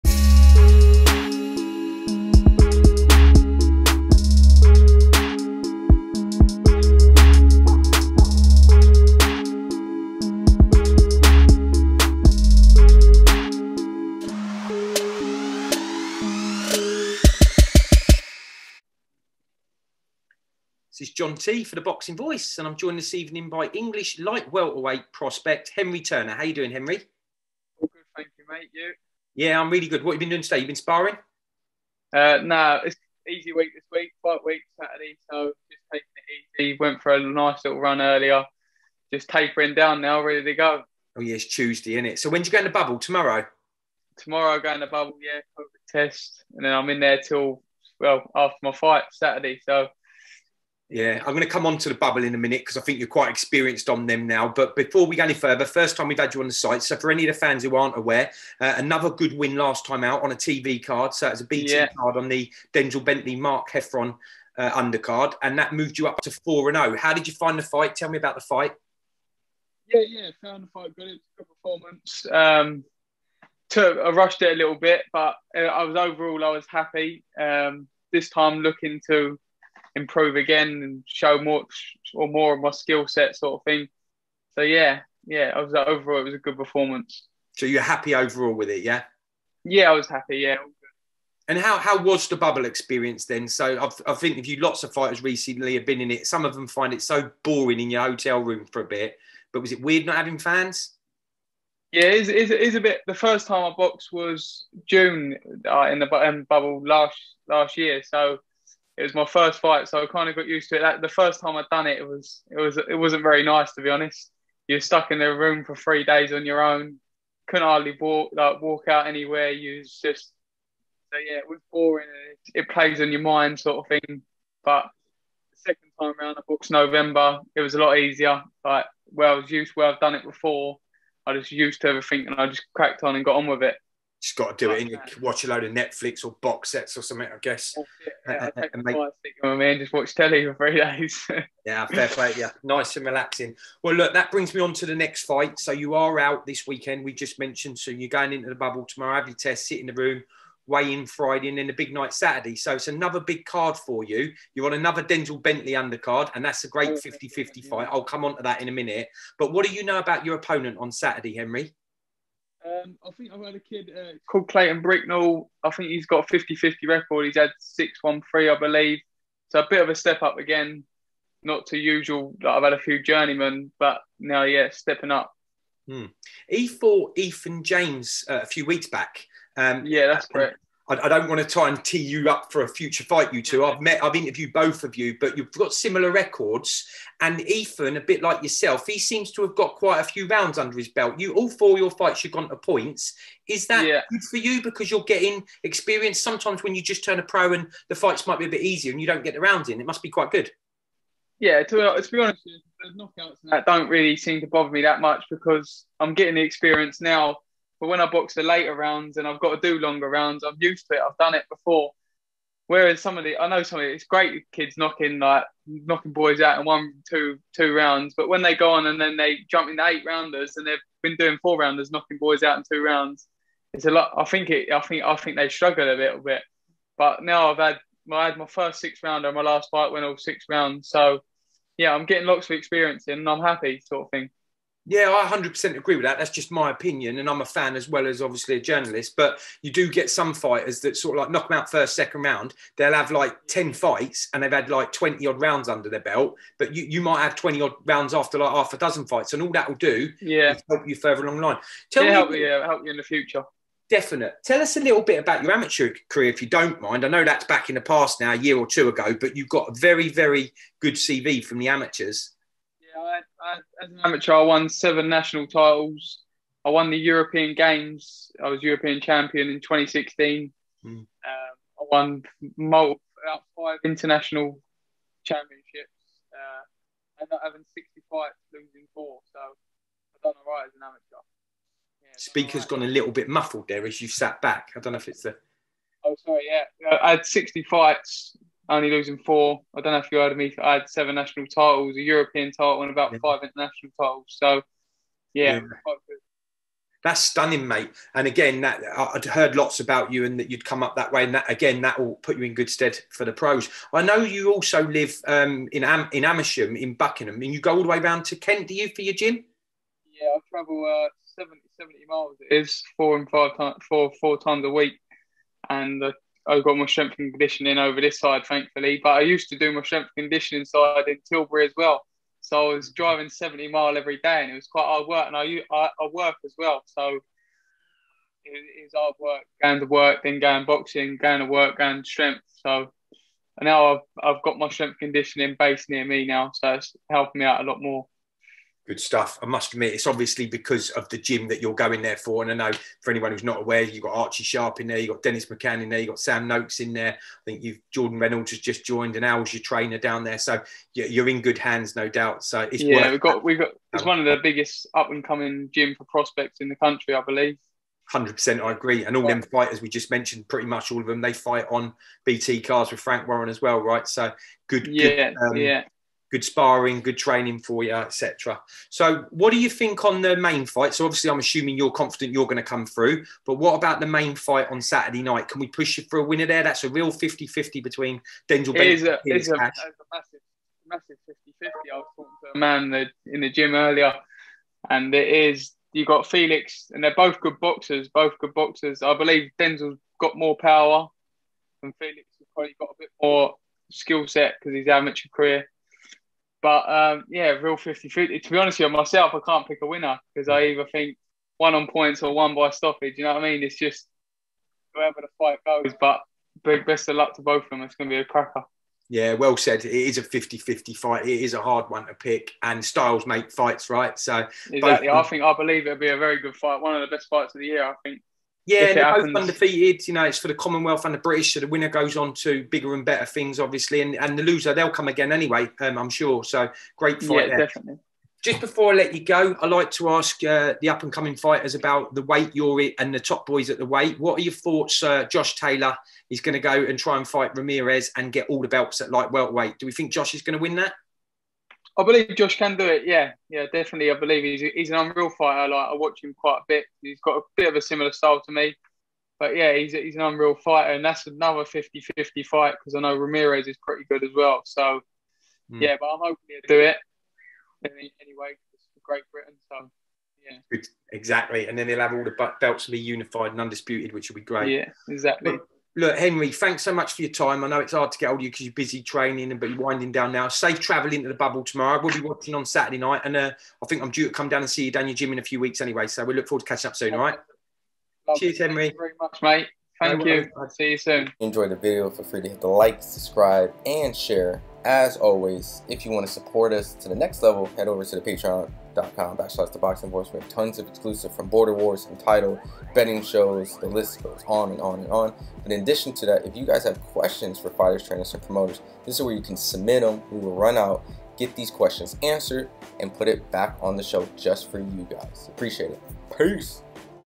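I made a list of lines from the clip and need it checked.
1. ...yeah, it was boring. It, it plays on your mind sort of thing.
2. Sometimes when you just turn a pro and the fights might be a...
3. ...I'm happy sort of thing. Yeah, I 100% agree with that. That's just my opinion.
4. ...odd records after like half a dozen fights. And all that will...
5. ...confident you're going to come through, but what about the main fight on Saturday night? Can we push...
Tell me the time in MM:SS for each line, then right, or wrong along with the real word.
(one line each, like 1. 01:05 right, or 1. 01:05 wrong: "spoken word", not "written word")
1. 02:01 right
2. 03:16 right
3. 03:53 right
4. 04:07 wrong: "rounds", not "records"
5. 06:11 right.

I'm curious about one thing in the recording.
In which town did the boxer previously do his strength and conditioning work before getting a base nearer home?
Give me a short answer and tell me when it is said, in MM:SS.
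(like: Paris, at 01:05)
Tilbury, at 05:21.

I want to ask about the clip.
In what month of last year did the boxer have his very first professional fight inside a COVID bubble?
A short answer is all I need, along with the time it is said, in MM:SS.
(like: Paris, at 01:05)
June, at 01:44.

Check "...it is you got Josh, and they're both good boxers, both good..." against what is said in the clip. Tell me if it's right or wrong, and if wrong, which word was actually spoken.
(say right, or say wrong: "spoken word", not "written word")
wrong: "Felix", not "Josh".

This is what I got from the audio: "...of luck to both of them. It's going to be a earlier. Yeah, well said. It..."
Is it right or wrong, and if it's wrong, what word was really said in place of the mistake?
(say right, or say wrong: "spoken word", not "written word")
wrong: "cracker", not "earlier".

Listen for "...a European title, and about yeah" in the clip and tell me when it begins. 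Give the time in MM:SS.
04:51.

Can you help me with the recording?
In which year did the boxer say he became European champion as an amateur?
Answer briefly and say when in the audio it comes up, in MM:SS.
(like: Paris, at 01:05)
2016, at 04:29.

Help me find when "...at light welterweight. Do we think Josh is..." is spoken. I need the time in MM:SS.
07:18.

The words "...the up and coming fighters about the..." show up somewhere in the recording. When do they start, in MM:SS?
07:10.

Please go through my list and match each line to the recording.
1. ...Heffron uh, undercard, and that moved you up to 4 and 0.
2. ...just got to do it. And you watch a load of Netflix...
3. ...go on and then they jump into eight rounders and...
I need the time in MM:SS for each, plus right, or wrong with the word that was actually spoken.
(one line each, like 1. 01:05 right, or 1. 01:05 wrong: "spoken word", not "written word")
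1. 01:03 right
2. 02:14 right
3. 03:38 right.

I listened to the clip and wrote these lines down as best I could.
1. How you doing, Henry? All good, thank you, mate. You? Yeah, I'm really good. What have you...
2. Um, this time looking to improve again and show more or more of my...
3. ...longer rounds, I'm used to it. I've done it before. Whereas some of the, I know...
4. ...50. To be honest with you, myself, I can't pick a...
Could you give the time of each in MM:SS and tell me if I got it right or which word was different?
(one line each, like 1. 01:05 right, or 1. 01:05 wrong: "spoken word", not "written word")
1. 00:26 right
2. 01:17 right
3. 03:29 right
4. 06:38 right.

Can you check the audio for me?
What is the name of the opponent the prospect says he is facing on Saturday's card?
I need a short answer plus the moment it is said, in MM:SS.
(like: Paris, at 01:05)
Clayton Bricknell, at 02:44.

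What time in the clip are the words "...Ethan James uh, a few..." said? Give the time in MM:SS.
02:57.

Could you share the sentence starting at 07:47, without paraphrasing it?
I know it's hard to get hold of you because you're busy training and but you're winding down now.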